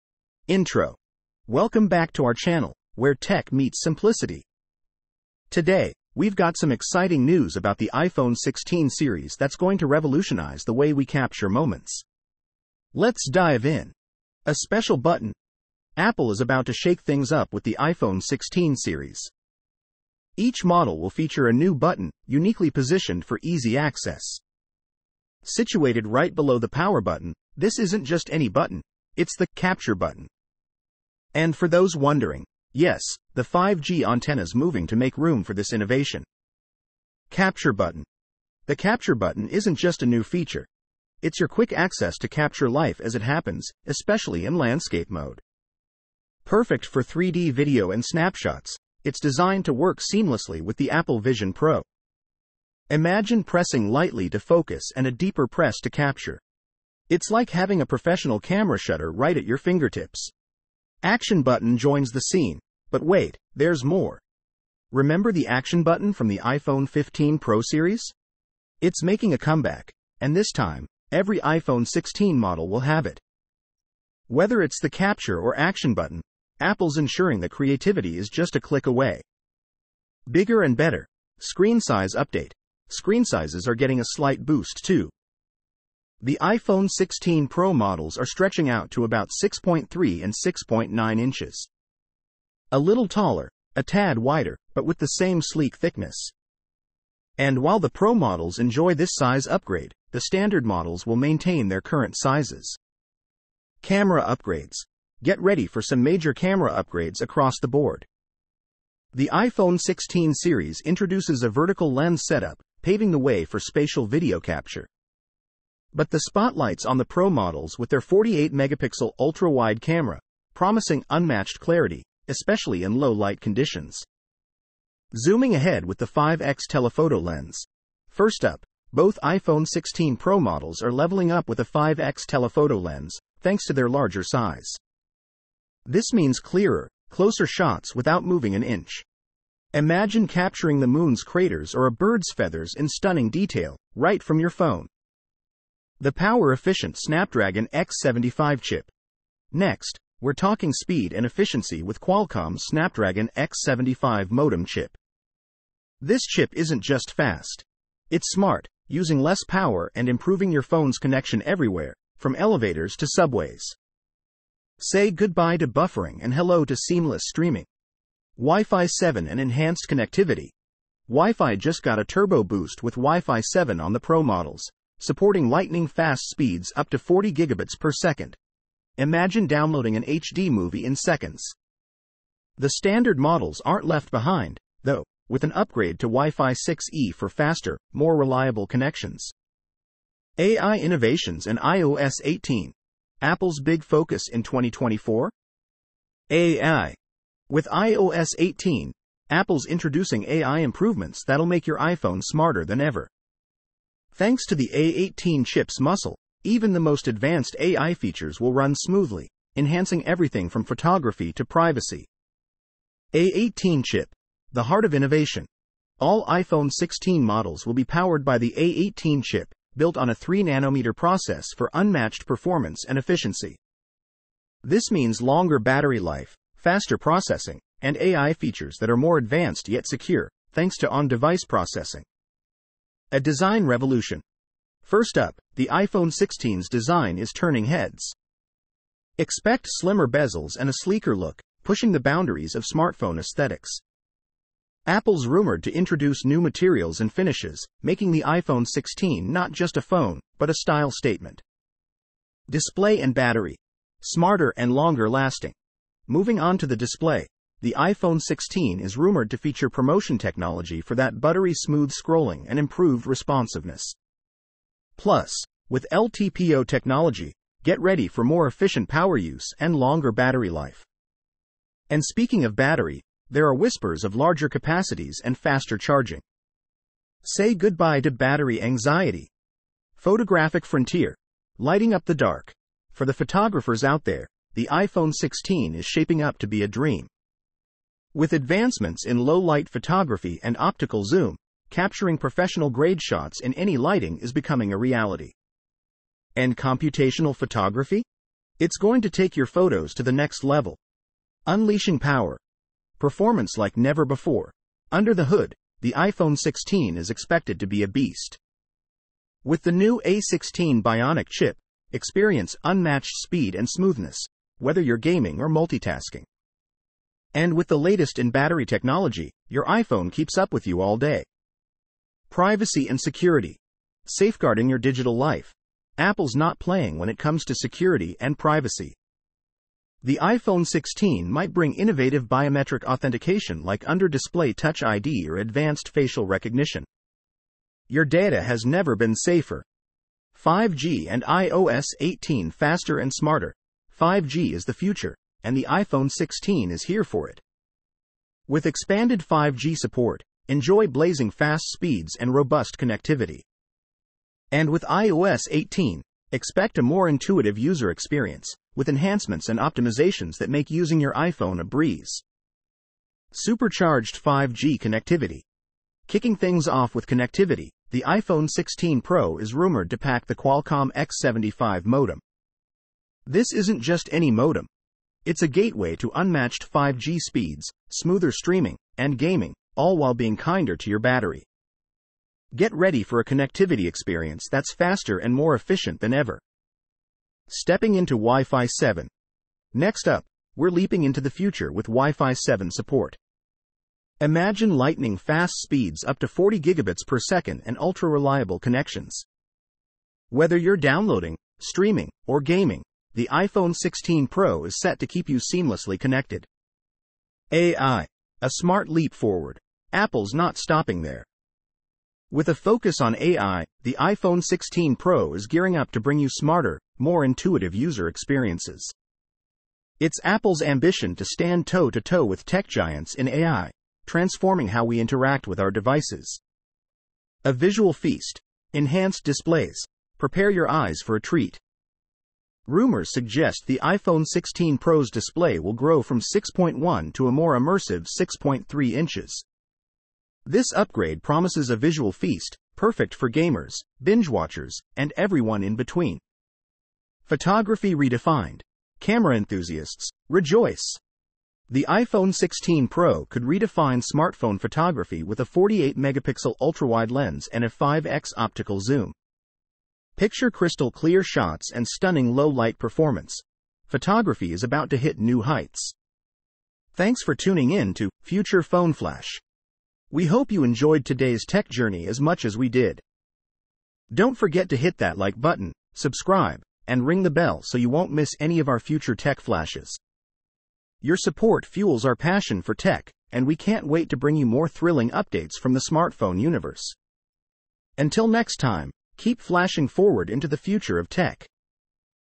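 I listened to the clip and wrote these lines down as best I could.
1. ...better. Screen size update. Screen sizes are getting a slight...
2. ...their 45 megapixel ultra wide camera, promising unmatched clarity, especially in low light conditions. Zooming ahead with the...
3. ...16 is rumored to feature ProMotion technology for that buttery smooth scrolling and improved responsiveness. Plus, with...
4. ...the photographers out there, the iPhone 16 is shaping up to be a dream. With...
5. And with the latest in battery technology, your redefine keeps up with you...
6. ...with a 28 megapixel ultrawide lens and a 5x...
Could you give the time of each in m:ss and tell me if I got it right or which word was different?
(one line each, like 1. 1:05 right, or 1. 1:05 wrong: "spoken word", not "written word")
1. 1:20 right
2. 1:57 wrong: "48", not "45"
3. 4:18 right
4. 4:43 right
5. 5:17 wrong: "iPhone", not "redefine"
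6. 7:35 wrong: "48", not "28".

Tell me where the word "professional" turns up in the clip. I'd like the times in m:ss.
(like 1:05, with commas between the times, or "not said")
0:57, 4:52.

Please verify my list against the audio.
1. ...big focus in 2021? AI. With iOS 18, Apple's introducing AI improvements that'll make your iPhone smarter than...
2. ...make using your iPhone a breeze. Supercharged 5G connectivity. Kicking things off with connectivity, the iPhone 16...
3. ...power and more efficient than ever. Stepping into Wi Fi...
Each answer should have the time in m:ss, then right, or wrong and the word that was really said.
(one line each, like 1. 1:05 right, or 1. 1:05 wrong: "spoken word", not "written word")
1. 3:13 wrong: "2024", not "2021"
2. 6:00 right
3. 6:24 wrong: "faster", not "power".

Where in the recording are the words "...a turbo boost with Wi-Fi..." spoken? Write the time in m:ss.
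2:51.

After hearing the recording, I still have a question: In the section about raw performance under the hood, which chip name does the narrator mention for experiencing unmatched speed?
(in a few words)
A16 Bionic.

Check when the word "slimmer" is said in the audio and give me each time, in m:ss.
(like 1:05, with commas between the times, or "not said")
3:59.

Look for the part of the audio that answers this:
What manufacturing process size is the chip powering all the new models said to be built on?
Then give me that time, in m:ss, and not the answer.
3:40.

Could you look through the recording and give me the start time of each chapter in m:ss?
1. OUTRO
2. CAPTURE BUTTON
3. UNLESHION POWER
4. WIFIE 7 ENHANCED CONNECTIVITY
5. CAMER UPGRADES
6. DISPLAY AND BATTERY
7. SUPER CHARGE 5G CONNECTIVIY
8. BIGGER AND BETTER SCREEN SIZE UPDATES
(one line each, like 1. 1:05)
1. 7:46
2. 0:35
3. 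5:01
4. 2:48
5. 1:44
6. 4:11
7. 6:02
8. 1:20.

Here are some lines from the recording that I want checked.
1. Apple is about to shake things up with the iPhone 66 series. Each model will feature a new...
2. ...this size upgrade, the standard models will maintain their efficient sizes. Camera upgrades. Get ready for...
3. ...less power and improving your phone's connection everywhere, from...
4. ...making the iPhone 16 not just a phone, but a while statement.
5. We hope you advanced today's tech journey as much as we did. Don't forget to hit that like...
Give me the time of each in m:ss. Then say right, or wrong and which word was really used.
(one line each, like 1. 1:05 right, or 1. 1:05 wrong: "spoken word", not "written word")
1. 0:15 wrong: "16", not "66"
2. 1:38 wrong: "current", not "efficient"
3. 2:39 right
4. 4:07 wrong: "style", not "while"
5. 7:50 wrong: "enjoyed", not "advanced".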